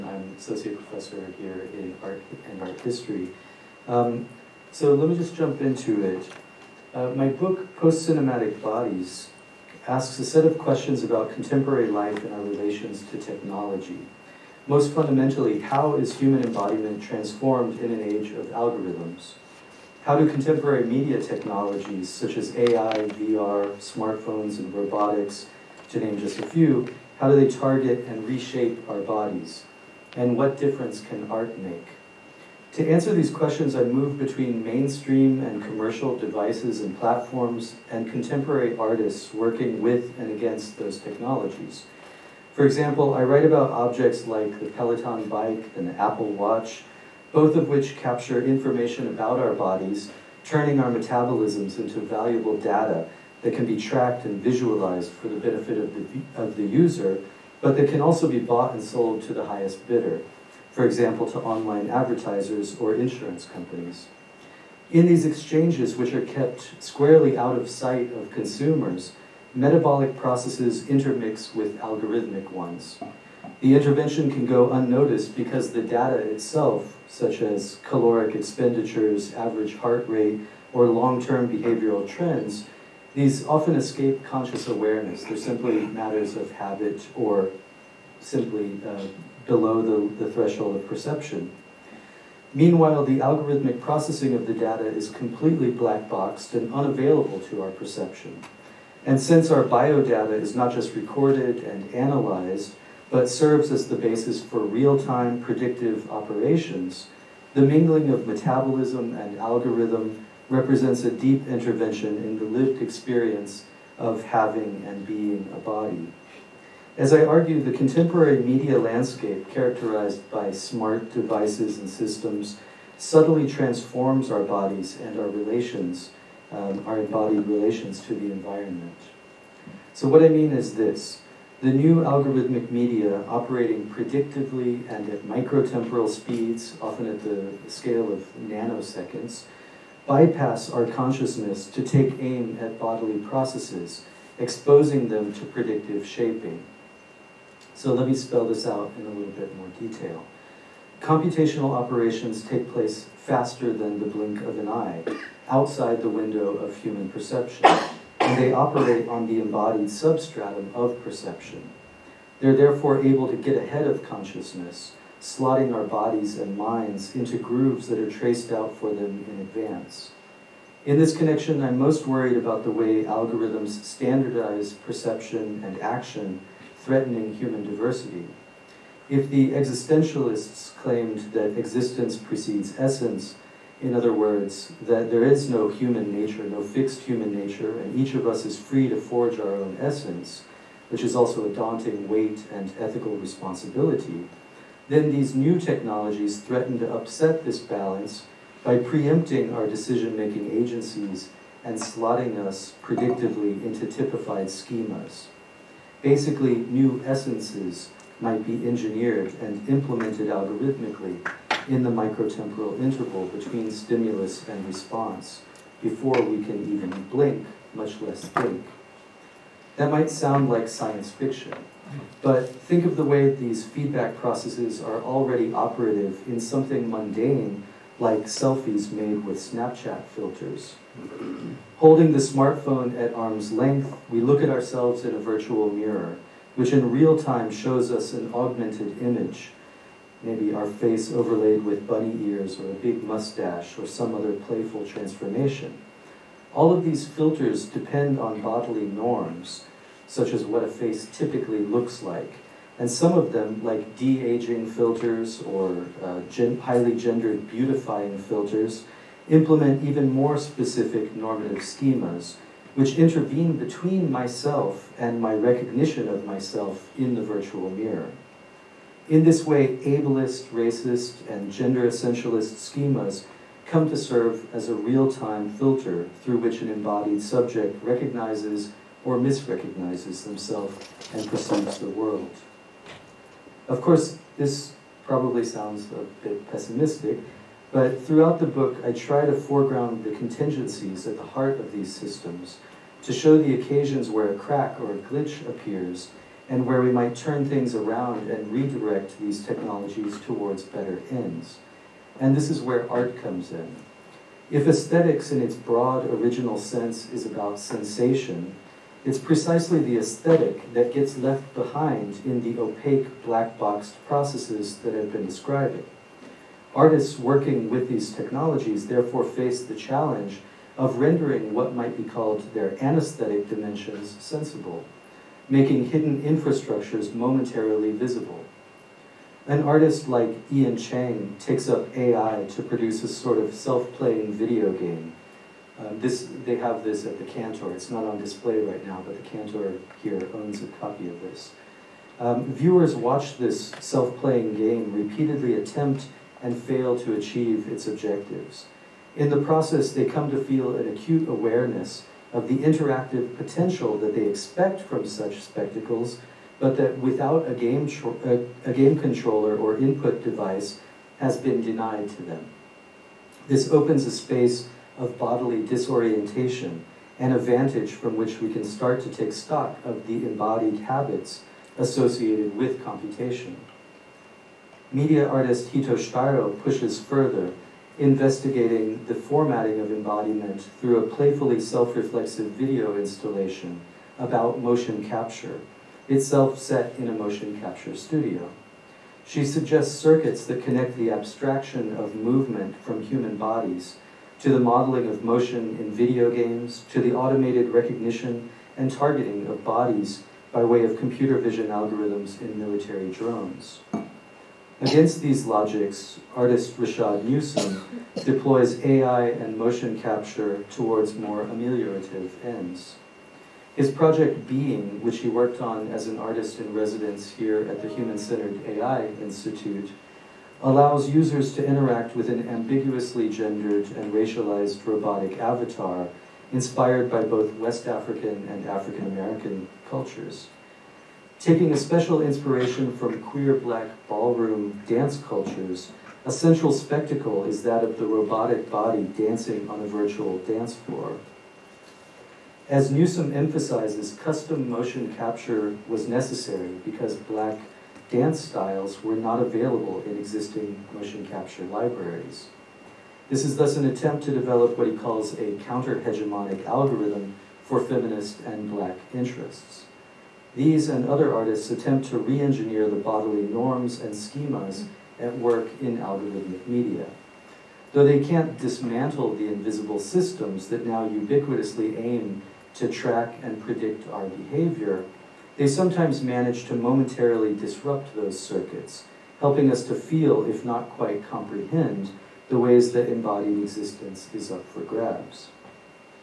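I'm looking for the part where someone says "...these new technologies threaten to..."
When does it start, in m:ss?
3:15.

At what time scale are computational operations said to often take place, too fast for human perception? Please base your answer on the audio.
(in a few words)
Nanoseconds.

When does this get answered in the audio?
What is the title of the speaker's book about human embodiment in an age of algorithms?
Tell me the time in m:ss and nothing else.
0:07.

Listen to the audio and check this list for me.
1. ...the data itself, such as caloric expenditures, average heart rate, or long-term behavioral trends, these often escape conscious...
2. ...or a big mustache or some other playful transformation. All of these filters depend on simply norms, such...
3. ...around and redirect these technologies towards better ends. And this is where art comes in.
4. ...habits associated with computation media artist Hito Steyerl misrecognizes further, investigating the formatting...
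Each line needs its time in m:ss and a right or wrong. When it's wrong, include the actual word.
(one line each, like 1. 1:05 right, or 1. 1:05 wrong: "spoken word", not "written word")
1. 1:15 right
2. 4:02 wrong: "bodily", not "simply"
3. 4:57 right
4. 6:10 wrong: "pushes", not "misrecognizes".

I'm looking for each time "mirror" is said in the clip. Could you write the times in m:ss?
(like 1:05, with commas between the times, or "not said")
3:55, 4:27.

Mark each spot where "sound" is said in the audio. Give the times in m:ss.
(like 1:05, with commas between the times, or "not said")
3:40, 4:45.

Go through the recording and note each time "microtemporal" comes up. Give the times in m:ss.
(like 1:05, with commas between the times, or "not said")
2:15, 3:31.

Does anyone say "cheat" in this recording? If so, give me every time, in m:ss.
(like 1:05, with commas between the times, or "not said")
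not said.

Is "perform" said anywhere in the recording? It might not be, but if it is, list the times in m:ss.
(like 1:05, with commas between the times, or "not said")
not said.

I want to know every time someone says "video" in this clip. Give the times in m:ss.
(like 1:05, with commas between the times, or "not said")
5:34, 6:22, 6:35.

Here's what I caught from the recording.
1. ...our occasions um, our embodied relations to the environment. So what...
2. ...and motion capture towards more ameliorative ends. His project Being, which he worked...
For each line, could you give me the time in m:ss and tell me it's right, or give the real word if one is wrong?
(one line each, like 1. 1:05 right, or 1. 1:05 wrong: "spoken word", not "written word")
1. 2:05 wrong: "relations", not "occasions"
2. 6:49 right.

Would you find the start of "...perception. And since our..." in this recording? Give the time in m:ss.
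1:37.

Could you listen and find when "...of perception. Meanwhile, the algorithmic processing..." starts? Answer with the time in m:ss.
1:30.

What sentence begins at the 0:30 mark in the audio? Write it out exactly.
And what difference can art make?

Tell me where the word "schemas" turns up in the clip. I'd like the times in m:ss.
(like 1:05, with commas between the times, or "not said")
3:24, 4:21, 4:32, 7:44.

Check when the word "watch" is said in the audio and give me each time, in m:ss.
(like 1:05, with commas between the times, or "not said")
0:46, 5:42.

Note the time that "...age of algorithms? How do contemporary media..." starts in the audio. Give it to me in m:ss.
0:18.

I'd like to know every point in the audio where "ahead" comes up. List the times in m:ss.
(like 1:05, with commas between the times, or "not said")
2:43.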